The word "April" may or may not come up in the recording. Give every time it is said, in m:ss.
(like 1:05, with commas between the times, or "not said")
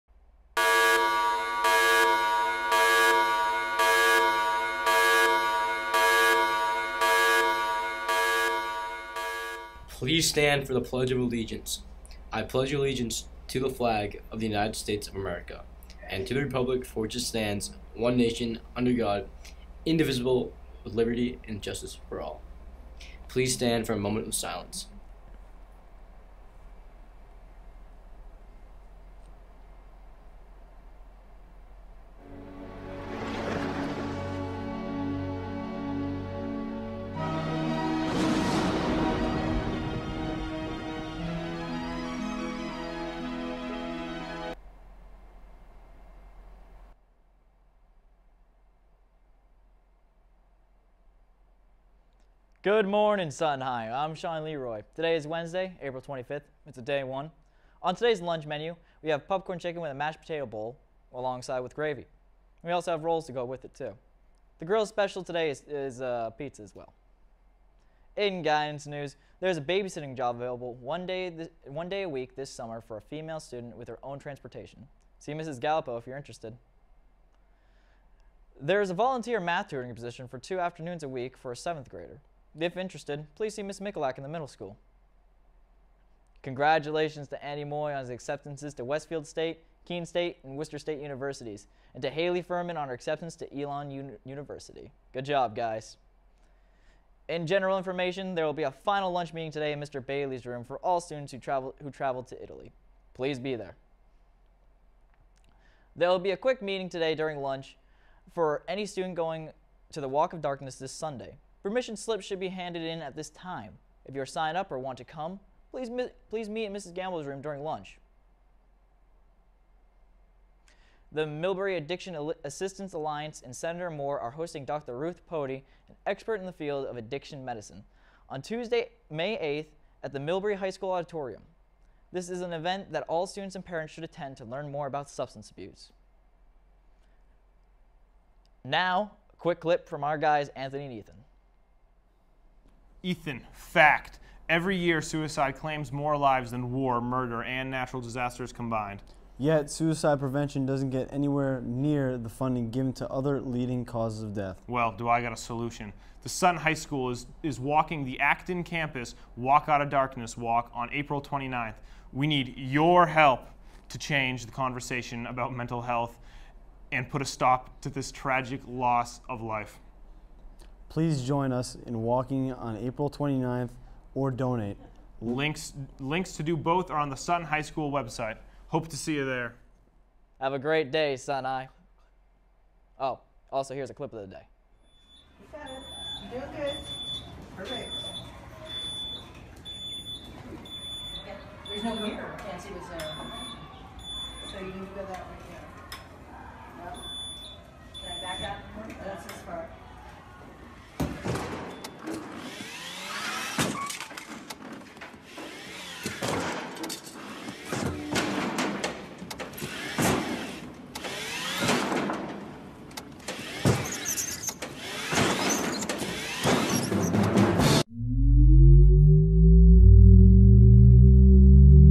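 0:55, 2:40, 2:52.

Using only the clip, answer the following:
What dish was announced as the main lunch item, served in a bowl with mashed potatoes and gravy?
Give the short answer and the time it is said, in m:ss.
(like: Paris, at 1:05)
popcorn chicken, at 0:59.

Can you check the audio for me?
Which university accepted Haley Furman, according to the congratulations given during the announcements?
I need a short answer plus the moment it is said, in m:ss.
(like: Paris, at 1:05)
Elon University, at 1:33.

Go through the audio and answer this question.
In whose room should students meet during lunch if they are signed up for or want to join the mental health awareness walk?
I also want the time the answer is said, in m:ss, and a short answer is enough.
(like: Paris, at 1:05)
Mrs. Gamble, at 1:56.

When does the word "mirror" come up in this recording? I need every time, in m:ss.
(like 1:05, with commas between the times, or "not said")
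3:12.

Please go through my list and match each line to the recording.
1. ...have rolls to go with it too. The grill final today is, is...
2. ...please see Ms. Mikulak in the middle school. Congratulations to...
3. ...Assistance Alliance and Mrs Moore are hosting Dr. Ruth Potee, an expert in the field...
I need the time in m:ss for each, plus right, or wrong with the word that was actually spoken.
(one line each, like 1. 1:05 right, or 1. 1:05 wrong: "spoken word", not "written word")
1. 1:02 wrong: "special", not "final"
2. 1:23 right
3. 2:02 wrong: "Senator", not "Mrs".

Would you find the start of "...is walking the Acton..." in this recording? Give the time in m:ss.
2:37.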